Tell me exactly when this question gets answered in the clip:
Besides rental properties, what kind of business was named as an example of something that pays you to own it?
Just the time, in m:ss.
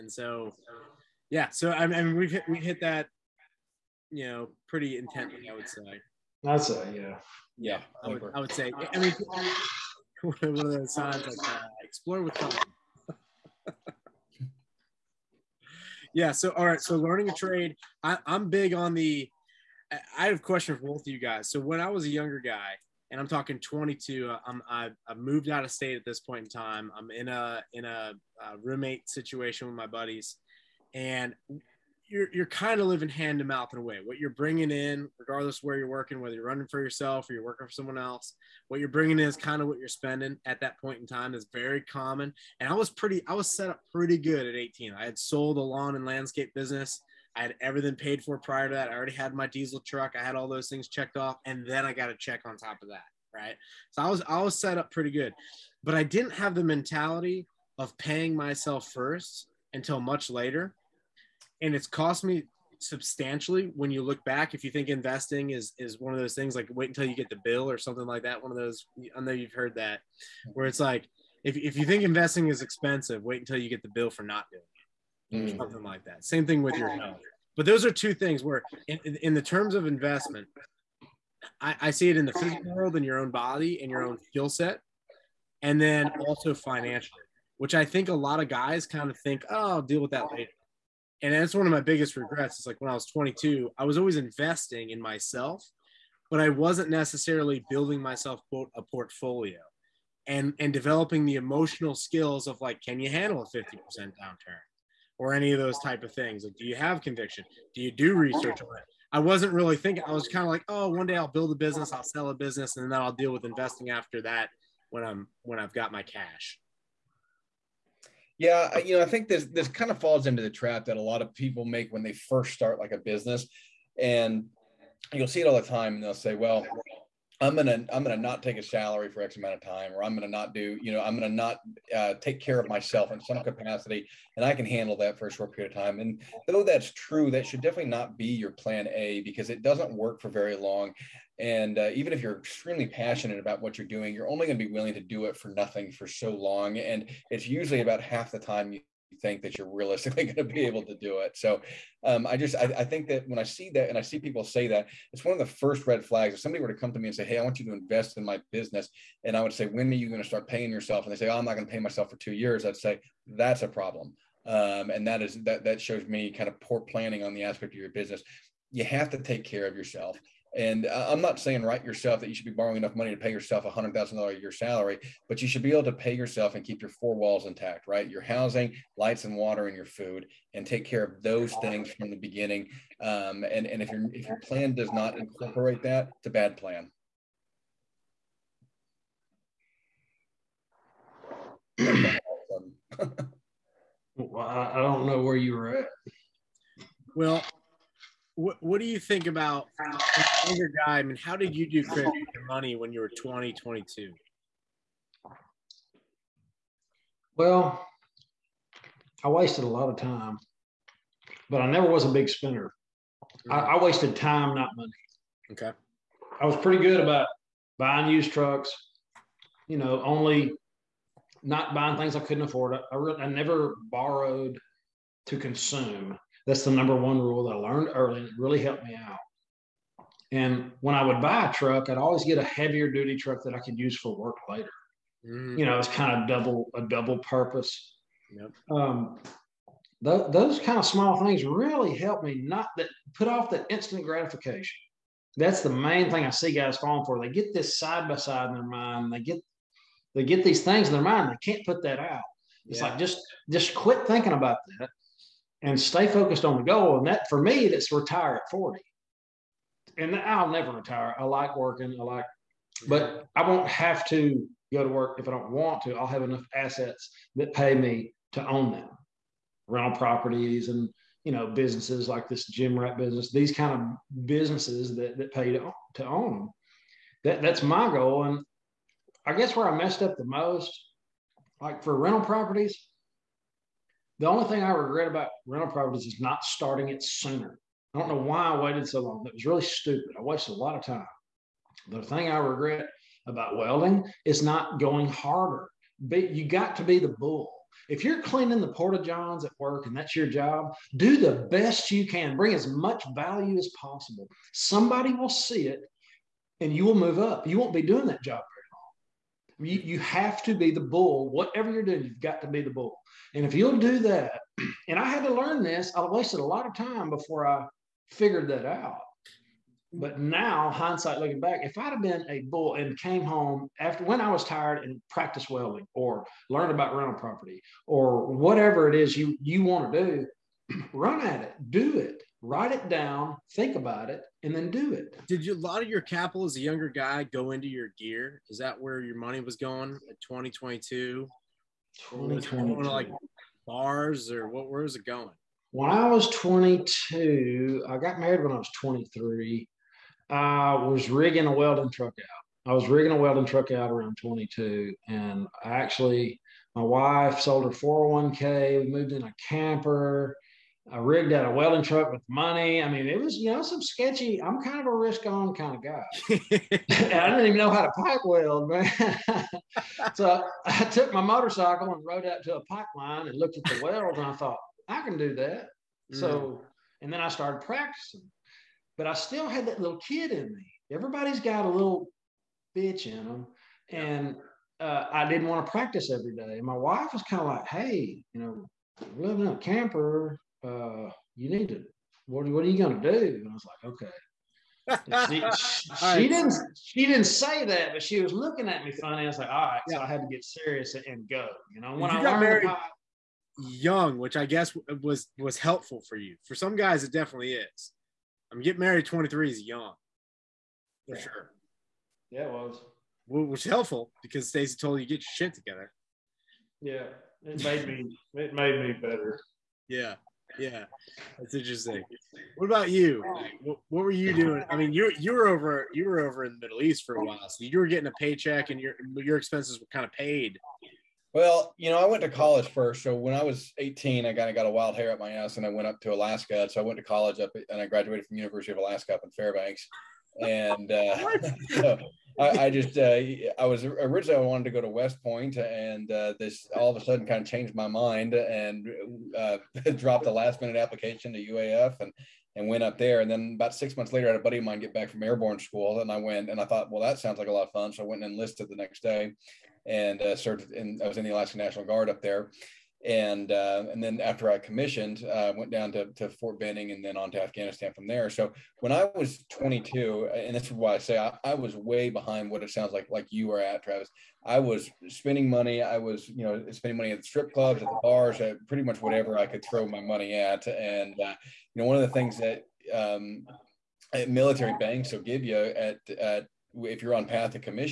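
4:32.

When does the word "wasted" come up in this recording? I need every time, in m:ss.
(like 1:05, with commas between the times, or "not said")
3:29, 3:33, 4:50, 5:16.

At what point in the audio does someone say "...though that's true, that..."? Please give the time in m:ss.
2:16.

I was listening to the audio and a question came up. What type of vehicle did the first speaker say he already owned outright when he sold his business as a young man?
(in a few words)
Diesel truck.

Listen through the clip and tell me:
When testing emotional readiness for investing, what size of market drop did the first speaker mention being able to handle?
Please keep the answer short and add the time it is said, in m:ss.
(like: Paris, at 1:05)
50%, at 1:43.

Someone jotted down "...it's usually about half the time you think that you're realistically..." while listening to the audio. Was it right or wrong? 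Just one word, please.
right.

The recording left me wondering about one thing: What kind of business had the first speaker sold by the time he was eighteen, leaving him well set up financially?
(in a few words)
Lawn and landscape business.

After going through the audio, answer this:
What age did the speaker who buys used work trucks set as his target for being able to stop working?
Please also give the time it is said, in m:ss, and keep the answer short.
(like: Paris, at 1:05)
40, at 4:18.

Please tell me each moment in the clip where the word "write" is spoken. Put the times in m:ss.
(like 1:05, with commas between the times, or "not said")
2:51, 5:32.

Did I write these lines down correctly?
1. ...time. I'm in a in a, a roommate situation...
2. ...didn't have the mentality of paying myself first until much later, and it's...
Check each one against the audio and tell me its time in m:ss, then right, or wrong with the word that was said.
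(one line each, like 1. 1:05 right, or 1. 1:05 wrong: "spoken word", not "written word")
1. 0:26 right
2. 0:56 right.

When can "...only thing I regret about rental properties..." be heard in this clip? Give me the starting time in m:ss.
4:44.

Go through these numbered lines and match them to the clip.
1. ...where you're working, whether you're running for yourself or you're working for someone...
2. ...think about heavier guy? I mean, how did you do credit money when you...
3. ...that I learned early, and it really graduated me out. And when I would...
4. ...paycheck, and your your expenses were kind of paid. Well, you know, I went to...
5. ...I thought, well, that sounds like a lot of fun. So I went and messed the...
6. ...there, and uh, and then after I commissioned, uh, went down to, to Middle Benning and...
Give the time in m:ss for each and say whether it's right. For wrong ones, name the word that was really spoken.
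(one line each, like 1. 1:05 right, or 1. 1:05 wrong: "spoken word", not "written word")
1. 0:35 right
2. 3:18 wrong: "younger", not "heavier"
3. 3:47 wrong: "helped", not "graduated"
4. 7:08 right
5. 7:36 wrong: "enlisted", not "messed"
6. 7:42 wrong: "Fort", not "Middle".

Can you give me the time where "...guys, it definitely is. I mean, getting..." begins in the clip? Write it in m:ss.
6:46.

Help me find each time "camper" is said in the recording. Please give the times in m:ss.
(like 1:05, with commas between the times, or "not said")
5:59, 6:29.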